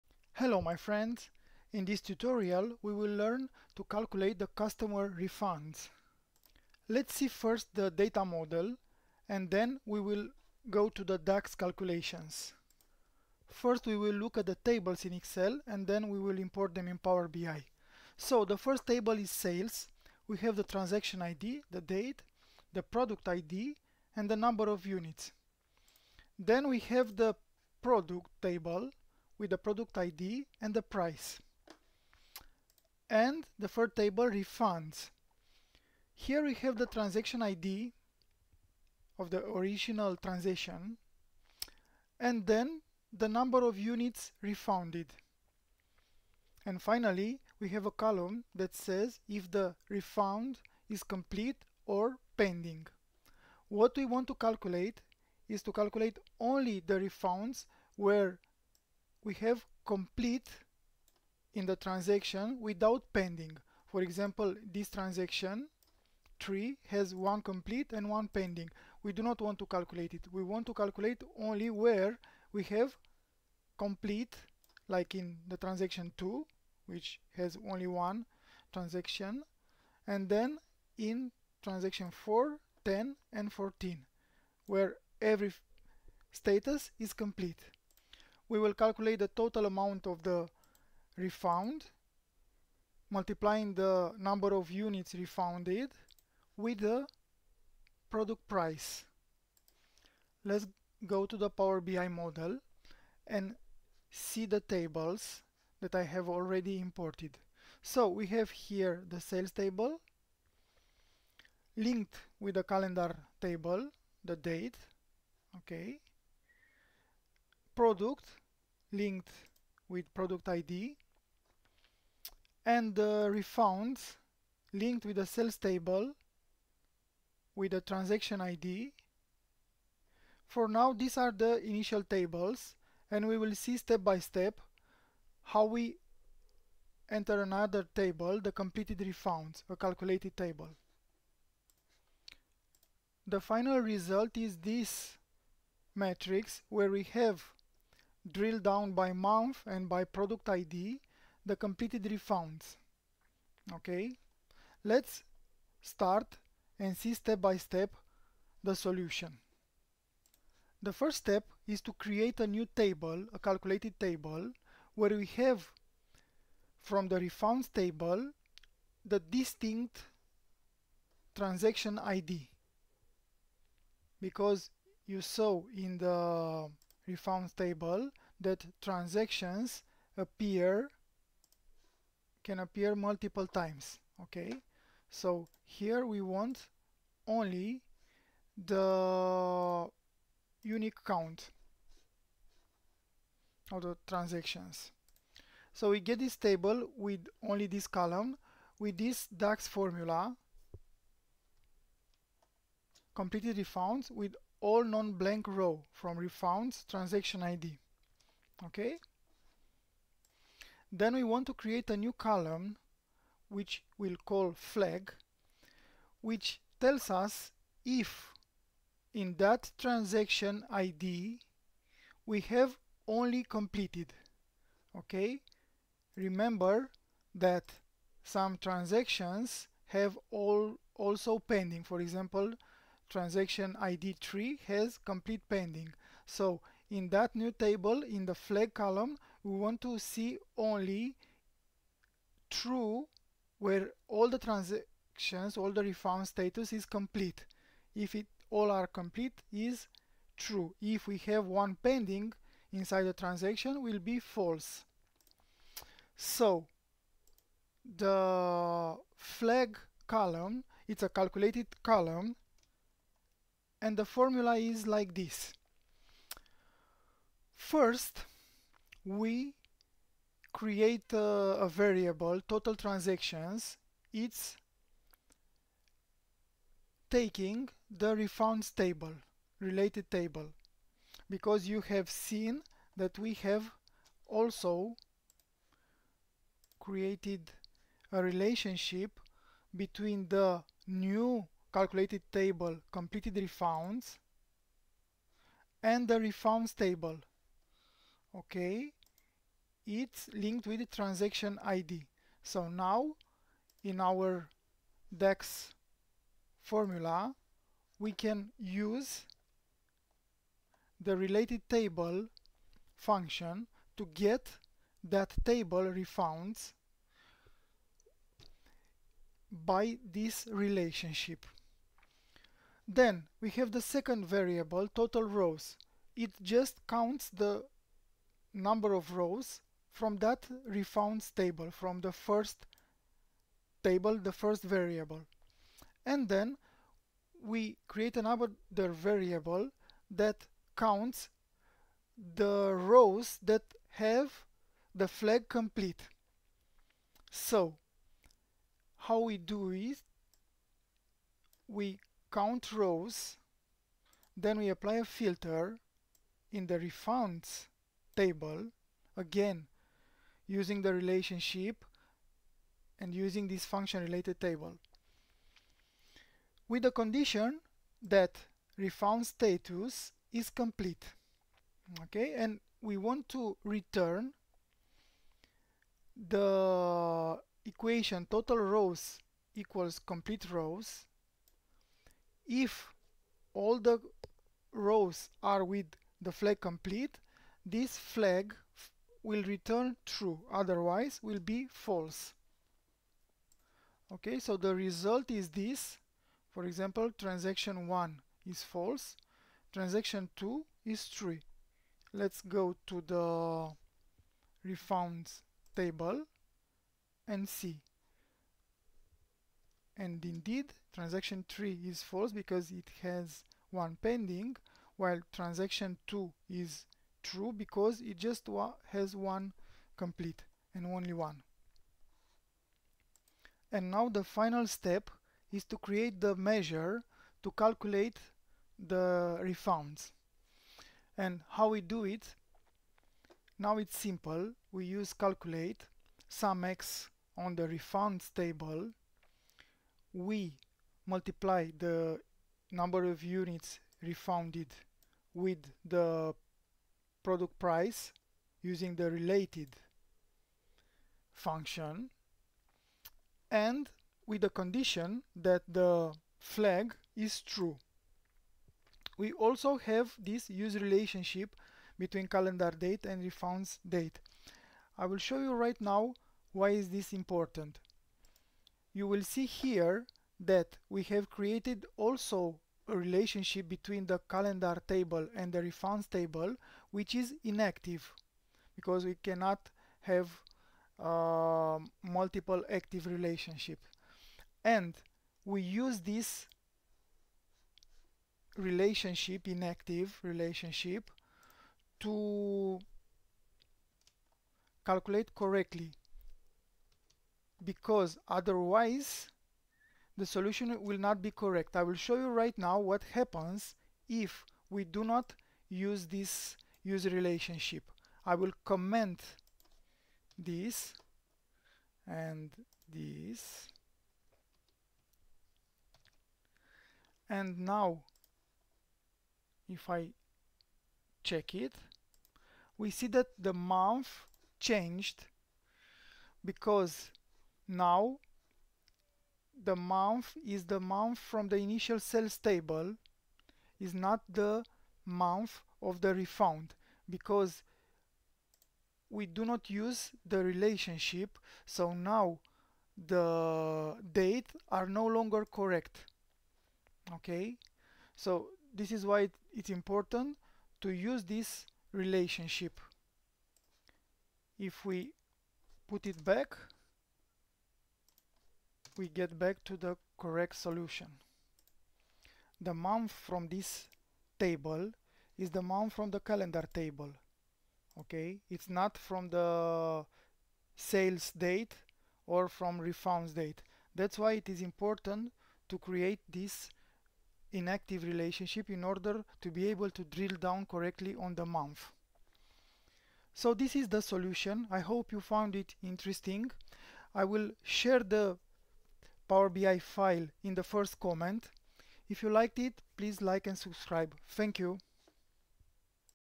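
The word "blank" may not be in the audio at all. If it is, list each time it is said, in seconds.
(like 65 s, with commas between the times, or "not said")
204 s.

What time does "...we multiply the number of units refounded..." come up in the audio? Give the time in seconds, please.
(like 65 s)
440 s.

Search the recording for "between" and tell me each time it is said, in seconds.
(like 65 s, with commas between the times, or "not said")
289 s, 461 s, 473 s.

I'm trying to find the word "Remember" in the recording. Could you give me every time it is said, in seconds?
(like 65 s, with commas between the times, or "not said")
226 s.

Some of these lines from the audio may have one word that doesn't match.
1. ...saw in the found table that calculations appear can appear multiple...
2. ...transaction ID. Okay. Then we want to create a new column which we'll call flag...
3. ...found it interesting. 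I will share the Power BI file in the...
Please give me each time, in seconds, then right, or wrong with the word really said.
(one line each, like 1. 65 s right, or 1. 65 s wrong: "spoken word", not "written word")
1. 175 s wrong: "transactions", not "calculations"
2. 206 s right
3. 585 s right.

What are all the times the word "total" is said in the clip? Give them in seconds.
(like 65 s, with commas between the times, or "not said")
89 s, 272 s, 324 s, 378 s.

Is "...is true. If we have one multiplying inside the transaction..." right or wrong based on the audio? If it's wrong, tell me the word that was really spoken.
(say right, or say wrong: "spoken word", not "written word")
wrong: "pending", not "multiplying".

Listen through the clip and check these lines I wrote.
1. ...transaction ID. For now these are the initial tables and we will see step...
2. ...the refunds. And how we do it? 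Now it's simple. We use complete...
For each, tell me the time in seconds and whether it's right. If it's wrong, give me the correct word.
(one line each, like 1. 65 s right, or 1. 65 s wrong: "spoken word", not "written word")
1. 127 s right
2. 428 s wrong: "calculate", not "complete".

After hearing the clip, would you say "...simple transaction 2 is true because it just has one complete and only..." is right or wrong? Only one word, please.
wrong.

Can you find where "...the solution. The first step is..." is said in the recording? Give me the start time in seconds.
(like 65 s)
158 s.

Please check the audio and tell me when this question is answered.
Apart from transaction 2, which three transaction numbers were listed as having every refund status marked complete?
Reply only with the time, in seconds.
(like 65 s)
82 s.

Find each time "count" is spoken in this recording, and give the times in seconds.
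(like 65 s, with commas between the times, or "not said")
191 s, 326 s, 340 s, 352 s.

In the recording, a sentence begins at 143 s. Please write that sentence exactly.
The final result is this matrix where we have drill down by month and by product ID the completed refunds.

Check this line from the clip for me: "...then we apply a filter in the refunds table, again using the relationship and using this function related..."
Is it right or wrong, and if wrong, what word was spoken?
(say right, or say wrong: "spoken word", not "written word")
right.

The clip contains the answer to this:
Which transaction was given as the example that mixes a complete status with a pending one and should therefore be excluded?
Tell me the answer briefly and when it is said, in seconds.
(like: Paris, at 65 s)
Transaction 3, at 64 s.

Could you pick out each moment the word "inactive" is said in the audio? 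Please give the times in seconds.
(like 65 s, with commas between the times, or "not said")
477 s, 489 s, 577 s.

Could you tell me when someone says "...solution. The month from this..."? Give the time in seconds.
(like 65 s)
560 s.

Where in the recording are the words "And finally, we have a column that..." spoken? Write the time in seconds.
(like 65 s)
46 s.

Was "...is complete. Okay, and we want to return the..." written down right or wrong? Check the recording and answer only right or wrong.
right.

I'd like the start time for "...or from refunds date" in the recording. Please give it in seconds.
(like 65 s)
572 s.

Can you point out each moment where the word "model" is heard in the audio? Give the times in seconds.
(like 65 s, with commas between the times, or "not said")
8 s, 102 s.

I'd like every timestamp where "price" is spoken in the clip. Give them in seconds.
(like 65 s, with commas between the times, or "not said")
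30 s, 98 s, 447 s.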